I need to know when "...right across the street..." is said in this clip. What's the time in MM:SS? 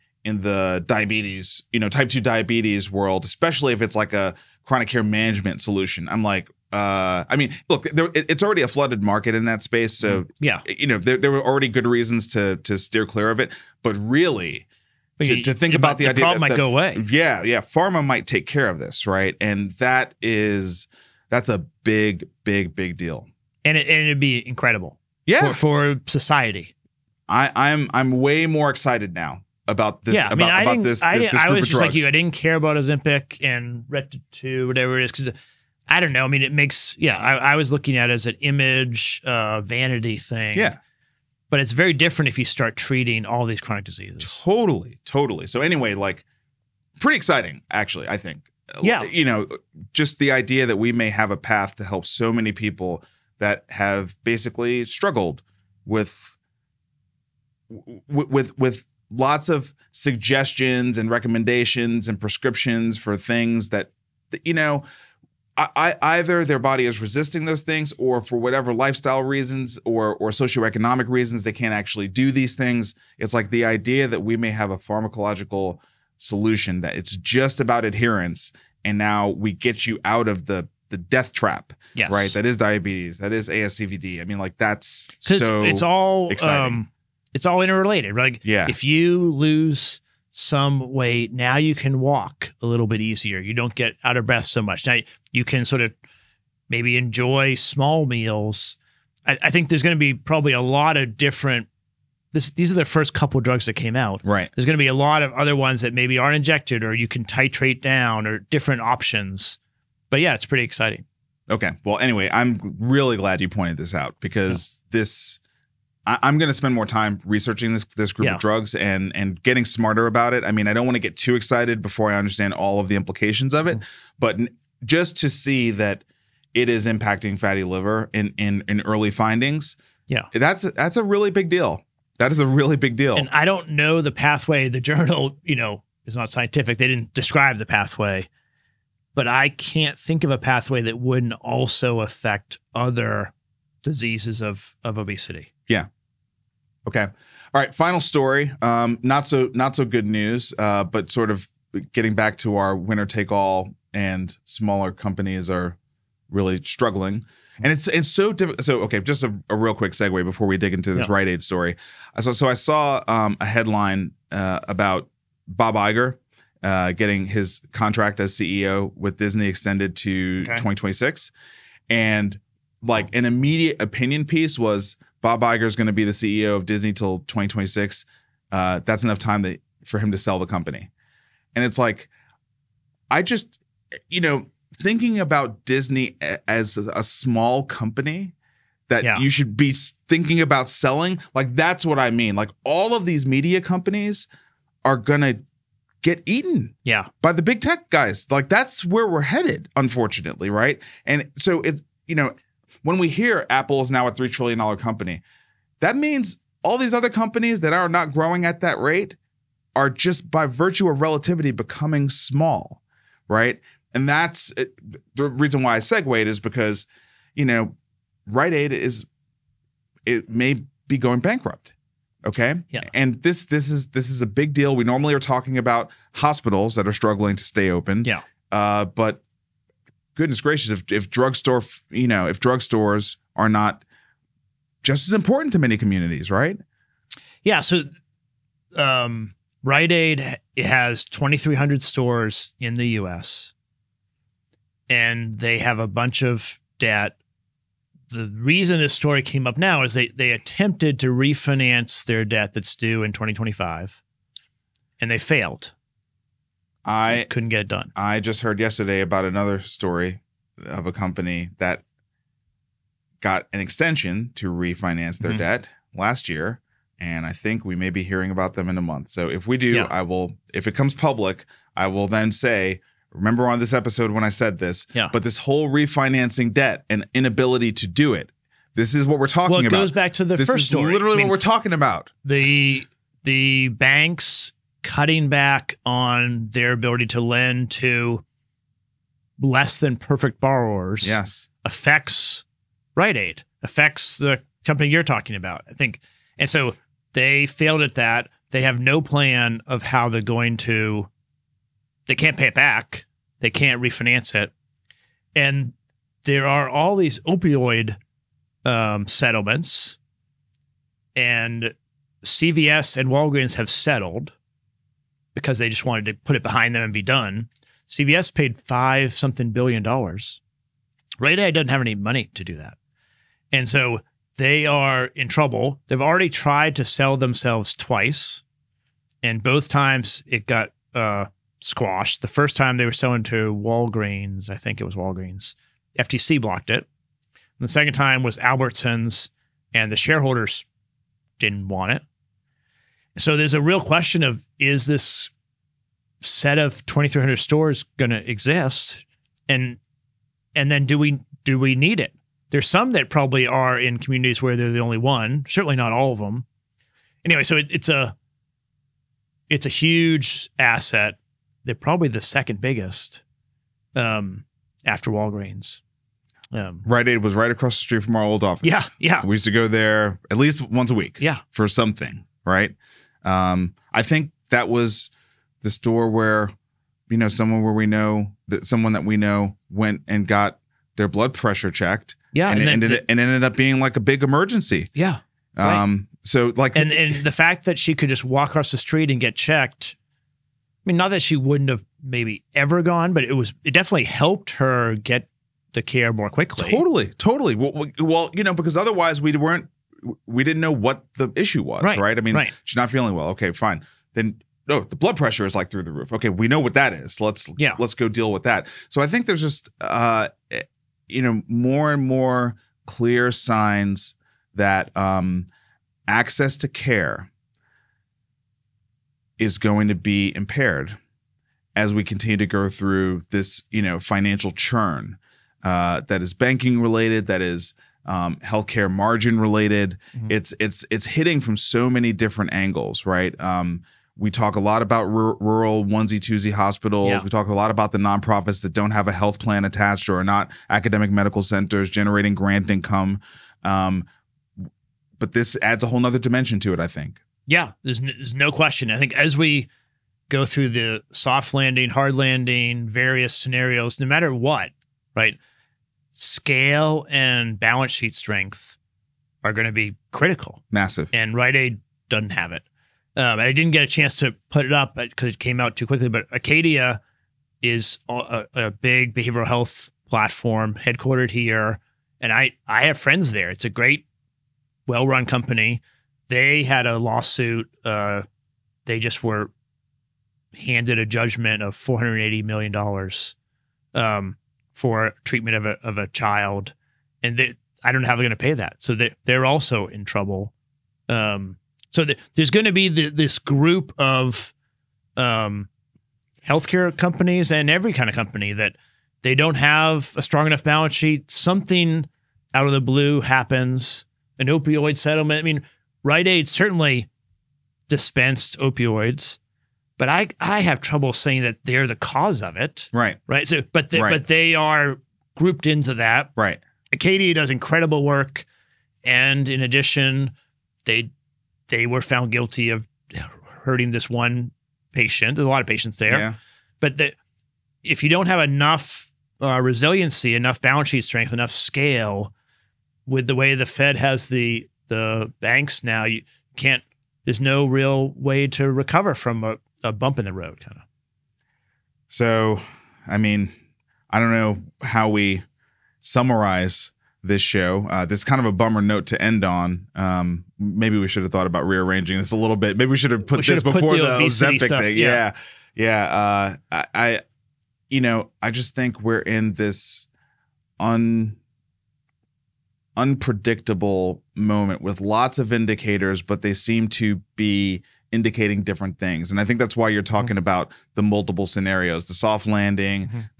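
06:07.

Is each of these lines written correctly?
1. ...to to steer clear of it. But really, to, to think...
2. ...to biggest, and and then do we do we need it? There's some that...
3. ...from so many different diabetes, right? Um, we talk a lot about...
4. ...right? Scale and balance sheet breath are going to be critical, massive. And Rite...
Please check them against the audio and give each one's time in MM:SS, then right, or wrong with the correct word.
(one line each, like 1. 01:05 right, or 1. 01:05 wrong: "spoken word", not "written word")
1. 00:12 right
2. 05:48 wrong: "exist", not "biggest"
3. 07:11 wrong: "angles", not "diabetes"
4. 07:35 wrong: "strength", not "breath".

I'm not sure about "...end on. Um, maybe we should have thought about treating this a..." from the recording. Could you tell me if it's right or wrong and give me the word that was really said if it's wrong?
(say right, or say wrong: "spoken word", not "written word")
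wrong: "rearranging", not "treating".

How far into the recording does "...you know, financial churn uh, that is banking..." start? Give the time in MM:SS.
07:03.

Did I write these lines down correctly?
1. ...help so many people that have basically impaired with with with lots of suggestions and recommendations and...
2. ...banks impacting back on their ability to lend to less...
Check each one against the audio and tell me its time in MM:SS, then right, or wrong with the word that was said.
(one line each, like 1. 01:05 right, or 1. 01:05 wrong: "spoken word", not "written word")
1. 00:51 wrong: "struggled", not "impaired"
2. 04:43 wrong: "cutting", not "impacting".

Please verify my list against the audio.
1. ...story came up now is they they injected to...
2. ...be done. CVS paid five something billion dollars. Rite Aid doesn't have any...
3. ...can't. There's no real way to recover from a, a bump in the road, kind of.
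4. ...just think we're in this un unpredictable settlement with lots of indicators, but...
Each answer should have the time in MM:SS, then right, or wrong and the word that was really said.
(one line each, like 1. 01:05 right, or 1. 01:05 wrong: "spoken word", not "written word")
1. 04:08 wrong: "attempted", not "injected"
2. 05:16 right
3. 08:56 right
4. 09:18 wrong: "moment", not "settlement".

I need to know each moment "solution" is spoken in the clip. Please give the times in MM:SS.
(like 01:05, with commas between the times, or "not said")
00:05, 01:16.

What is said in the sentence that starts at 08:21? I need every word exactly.
Something out of the blue happens, an opioid settlement.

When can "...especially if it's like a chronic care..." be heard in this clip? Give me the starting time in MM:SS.
00:03.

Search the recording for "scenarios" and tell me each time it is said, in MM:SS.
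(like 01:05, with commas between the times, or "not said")
07:33, 09:31.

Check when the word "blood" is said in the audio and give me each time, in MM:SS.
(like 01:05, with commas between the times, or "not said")
06:21, 06:44.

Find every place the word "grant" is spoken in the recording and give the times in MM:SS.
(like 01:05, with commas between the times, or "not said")
07:22.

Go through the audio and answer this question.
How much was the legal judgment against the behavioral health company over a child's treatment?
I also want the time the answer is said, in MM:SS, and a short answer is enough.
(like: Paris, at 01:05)
$480 million, at 08:01.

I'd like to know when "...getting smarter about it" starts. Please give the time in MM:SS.
01:59.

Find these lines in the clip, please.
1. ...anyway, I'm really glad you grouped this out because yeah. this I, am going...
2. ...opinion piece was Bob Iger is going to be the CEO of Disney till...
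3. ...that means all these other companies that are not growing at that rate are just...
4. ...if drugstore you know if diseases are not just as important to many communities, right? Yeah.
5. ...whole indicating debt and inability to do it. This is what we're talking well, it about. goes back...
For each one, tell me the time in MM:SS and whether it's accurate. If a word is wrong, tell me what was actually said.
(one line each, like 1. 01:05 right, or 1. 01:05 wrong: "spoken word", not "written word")
1. 01:51 wrong: "pointed", not "grouped"
2. 02:53 right
3. 03:25 right
4. 03:50 wrong: "drugstores", not "diseases"
5. 04:35 wrong: "refinancing", not "indicating".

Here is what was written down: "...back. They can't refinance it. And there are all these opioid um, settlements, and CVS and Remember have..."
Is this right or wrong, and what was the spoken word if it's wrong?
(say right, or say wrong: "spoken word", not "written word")
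wrong: "Walgreens", not "Remember".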